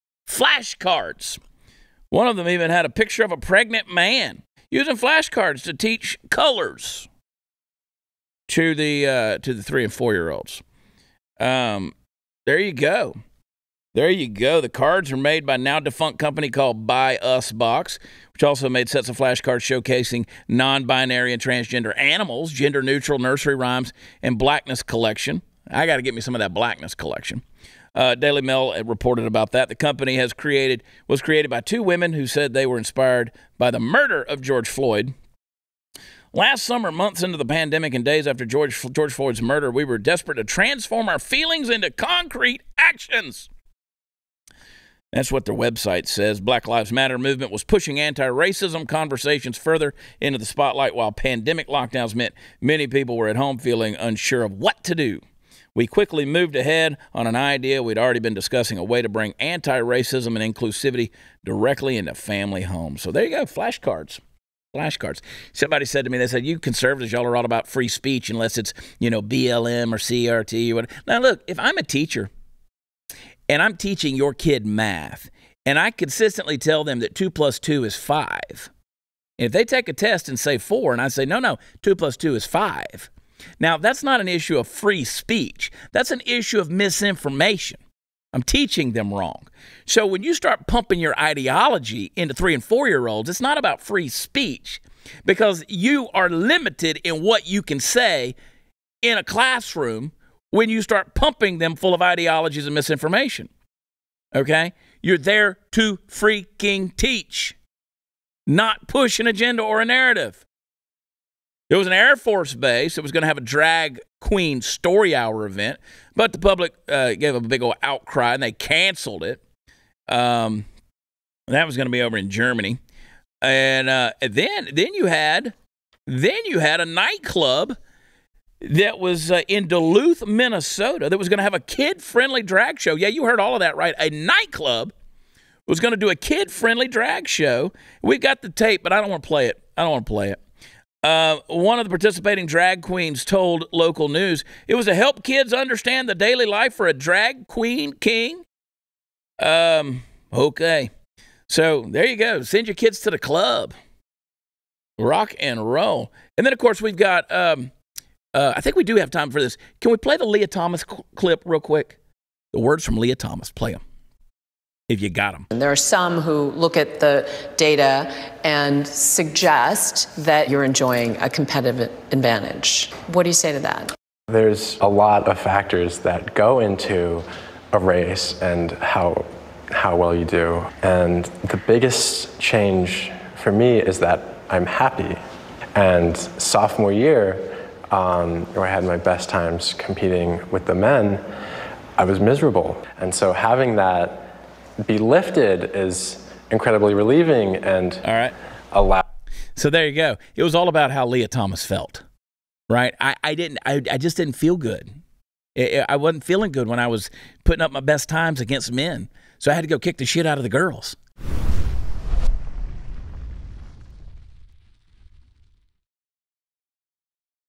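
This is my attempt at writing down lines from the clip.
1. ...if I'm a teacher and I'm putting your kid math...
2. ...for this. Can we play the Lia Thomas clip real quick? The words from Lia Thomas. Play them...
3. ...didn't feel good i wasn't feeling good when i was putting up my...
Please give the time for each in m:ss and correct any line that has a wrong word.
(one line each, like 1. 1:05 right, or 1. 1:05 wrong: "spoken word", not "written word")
1. 1:11 wrong: "teaching", not "putting"
2. 2:39 right
3. 3:24 right.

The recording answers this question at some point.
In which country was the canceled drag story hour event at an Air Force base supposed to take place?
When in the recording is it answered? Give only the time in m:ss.
2:02.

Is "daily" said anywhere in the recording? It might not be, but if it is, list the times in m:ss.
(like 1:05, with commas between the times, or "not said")
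0:28, 2:26.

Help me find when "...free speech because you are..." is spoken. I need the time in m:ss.
1:33.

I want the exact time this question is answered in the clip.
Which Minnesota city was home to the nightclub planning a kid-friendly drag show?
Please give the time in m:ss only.
2:09.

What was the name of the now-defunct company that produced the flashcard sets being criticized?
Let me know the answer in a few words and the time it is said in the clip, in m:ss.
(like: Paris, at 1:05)
Buy Us Box, at 0:16.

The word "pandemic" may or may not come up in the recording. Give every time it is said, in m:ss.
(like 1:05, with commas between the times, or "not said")
0:37, 0:51.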